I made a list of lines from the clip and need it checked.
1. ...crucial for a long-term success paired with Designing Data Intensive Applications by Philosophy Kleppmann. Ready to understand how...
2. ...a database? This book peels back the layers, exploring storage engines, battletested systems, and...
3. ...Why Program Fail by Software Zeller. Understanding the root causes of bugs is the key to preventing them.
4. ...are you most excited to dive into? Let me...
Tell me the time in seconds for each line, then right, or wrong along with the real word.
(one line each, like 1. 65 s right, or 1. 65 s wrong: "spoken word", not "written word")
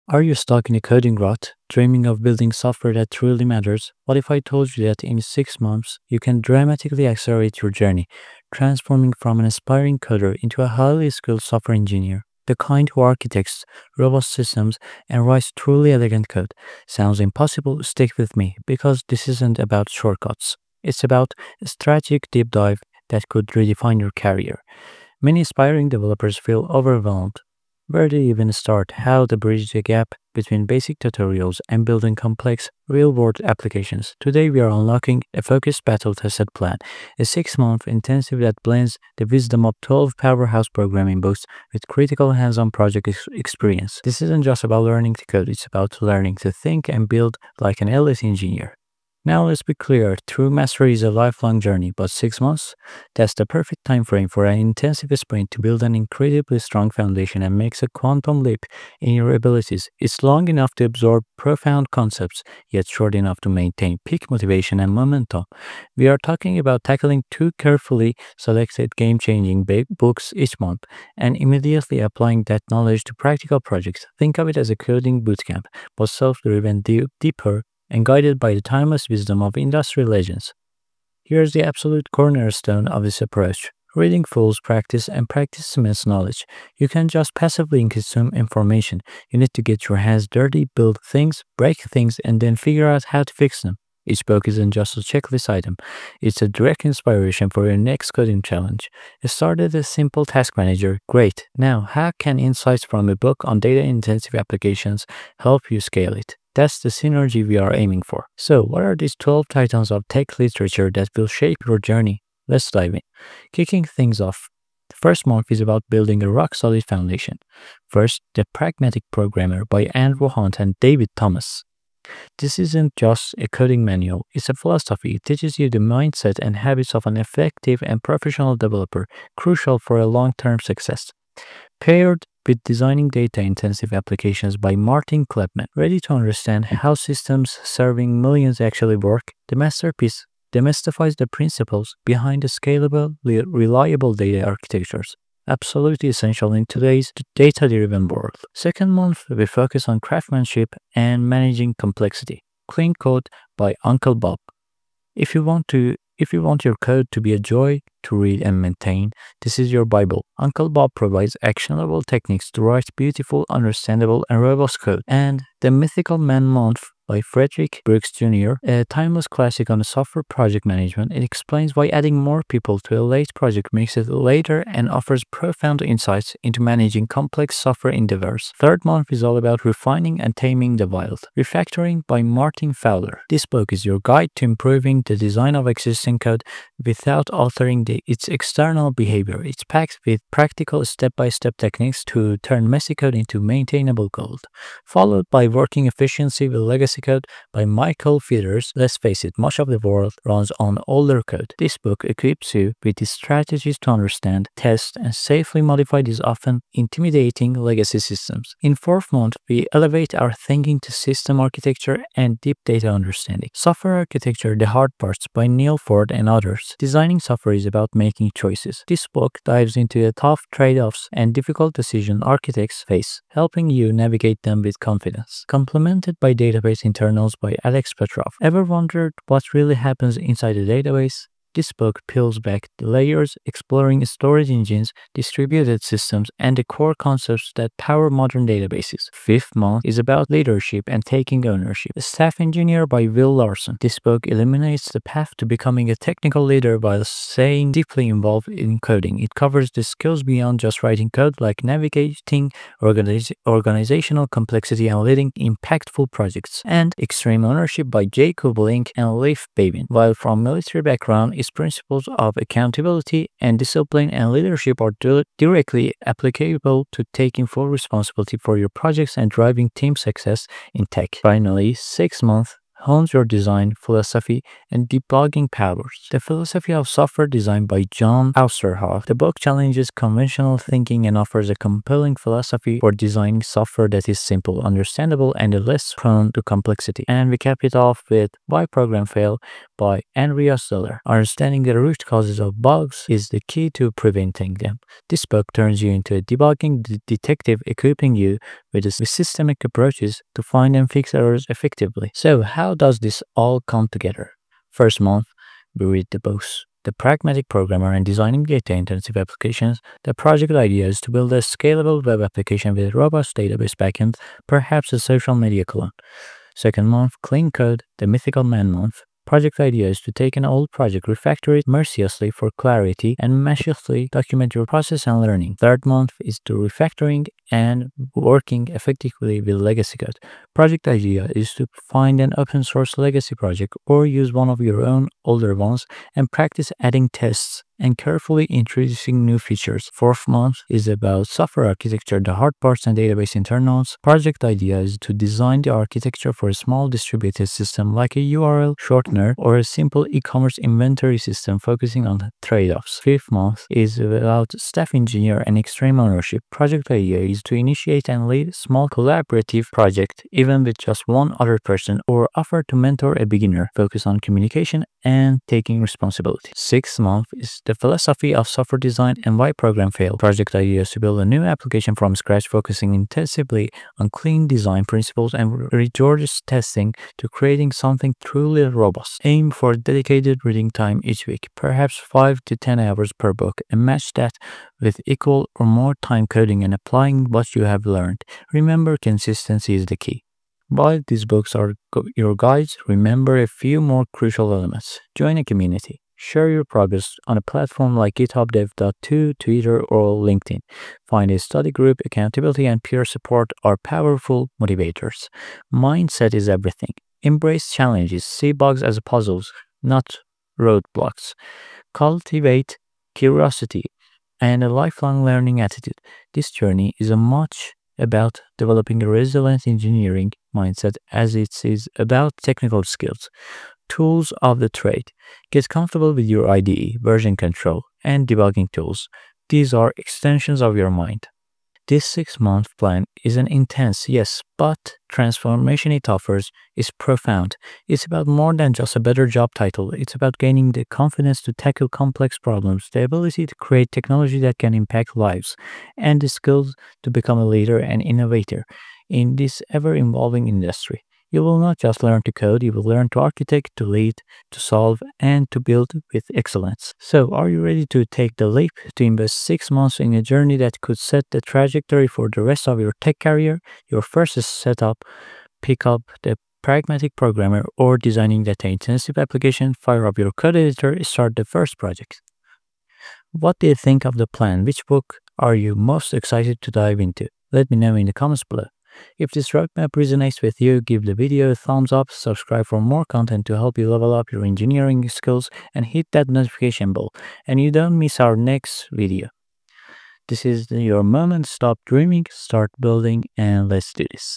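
1. 129 s wrong: "Martin", not "Philosophy"
2. 230 s wrong: "distributed", not "battletested"
3. 288 s wrong: "Andreas", not "Software"
4. 475 s right.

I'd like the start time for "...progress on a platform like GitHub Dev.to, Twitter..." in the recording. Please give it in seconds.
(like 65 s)
396 s.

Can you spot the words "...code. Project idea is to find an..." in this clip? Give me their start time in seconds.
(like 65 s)
329 s.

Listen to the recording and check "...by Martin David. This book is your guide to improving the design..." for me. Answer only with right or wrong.
wrong.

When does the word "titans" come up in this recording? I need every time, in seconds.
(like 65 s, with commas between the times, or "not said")
109 s.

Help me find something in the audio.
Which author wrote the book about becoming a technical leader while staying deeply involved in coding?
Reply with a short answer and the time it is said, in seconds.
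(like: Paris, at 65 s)
Will Larson, at 243 s.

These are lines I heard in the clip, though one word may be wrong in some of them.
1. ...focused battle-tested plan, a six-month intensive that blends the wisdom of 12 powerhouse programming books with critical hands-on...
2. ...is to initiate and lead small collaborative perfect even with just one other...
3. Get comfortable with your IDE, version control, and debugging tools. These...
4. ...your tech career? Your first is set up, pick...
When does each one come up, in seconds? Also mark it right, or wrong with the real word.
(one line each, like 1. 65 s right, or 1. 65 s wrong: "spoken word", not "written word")
1. 35 s right
2. 357 s wrong: "project", not "perfect"
3. 425 s right
4. 462 s right.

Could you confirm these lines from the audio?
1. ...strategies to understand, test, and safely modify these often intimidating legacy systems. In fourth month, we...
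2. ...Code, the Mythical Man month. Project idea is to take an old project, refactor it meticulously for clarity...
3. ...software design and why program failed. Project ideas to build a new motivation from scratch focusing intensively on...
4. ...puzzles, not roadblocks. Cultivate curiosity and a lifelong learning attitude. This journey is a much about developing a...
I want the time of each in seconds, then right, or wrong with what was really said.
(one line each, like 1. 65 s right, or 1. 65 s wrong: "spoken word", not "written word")
1. 203 s right
2. 317 s wrong: "mercilessly", not "meticulously"
3. 368 s wrong: "application", not "motivation"
4. 409 s right.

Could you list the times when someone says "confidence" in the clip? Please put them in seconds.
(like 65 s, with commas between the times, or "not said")
224 s, 440 s.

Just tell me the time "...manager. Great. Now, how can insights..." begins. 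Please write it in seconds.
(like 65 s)
100 s.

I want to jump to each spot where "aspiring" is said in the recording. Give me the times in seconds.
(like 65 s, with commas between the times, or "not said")
9 s, 25 s.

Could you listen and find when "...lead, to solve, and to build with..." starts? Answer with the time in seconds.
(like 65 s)
453 s.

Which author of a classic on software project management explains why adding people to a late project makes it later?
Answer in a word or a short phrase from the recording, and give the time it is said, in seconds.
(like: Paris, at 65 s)
Frederick Brooks Jr., at 167 s.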